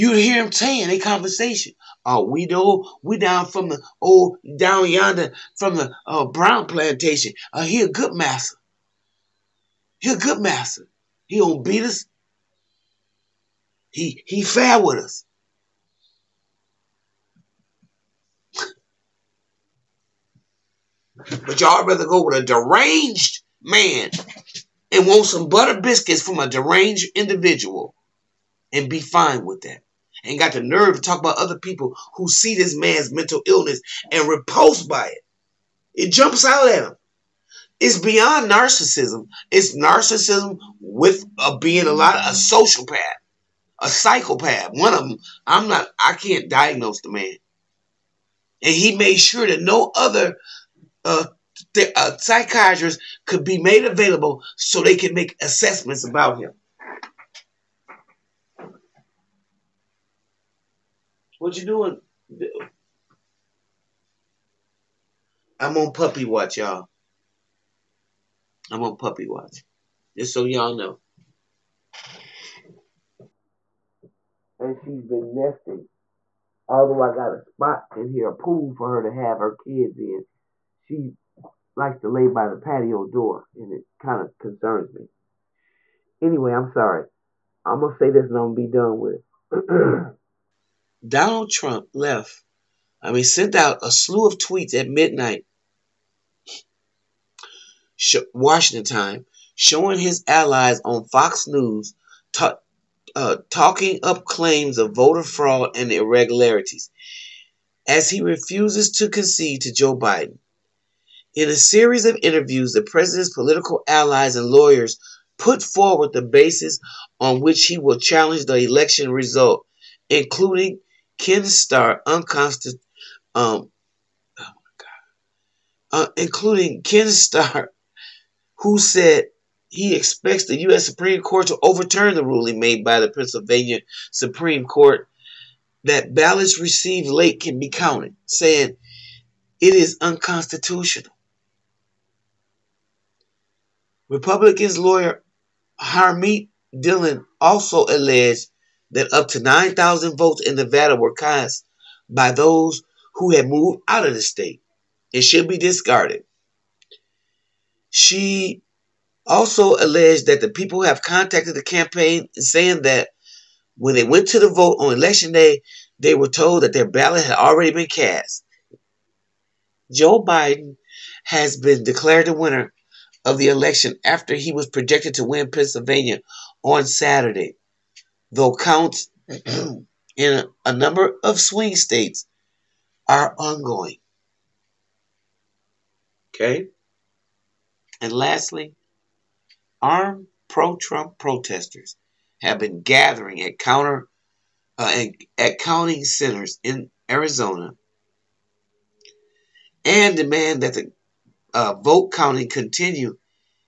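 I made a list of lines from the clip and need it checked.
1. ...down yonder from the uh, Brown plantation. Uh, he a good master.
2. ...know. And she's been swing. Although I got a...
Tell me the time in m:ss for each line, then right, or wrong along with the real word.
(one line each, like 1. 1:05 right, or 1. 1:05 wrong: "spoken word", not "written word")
1. 0:04 right
2. 1:10 wrong: "nesting", not "swing".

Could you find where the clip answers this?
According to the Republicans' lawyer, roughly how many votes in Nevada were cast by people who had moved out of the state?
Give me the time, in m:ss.
2:29.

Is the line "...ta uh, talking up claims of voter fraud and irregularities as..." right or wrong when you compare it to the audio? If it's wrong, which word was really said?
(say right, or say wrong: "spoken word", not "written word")
right.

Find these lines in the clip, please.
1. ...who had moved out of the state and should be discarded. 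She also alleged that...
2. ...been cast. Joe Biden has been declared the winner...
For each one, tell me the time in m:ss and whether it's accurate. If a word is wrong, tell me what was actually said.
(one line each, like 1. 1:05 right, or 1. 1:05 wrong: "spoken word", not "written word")
1. 2:33 right
2. 2:47 right.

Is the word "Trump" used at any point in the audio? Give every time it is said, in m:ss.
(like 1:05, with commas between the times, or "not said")
1:31, 3:10.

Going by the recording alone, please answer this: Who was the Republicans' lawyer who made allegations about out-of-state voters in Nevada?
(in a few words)
Harmeet Dillon.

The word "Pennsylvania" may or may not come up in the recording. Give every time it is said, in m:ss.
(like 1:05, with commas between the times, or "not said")
2:13, 2:55.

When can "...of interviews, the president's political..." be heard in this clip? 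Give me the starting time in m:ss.
1:52.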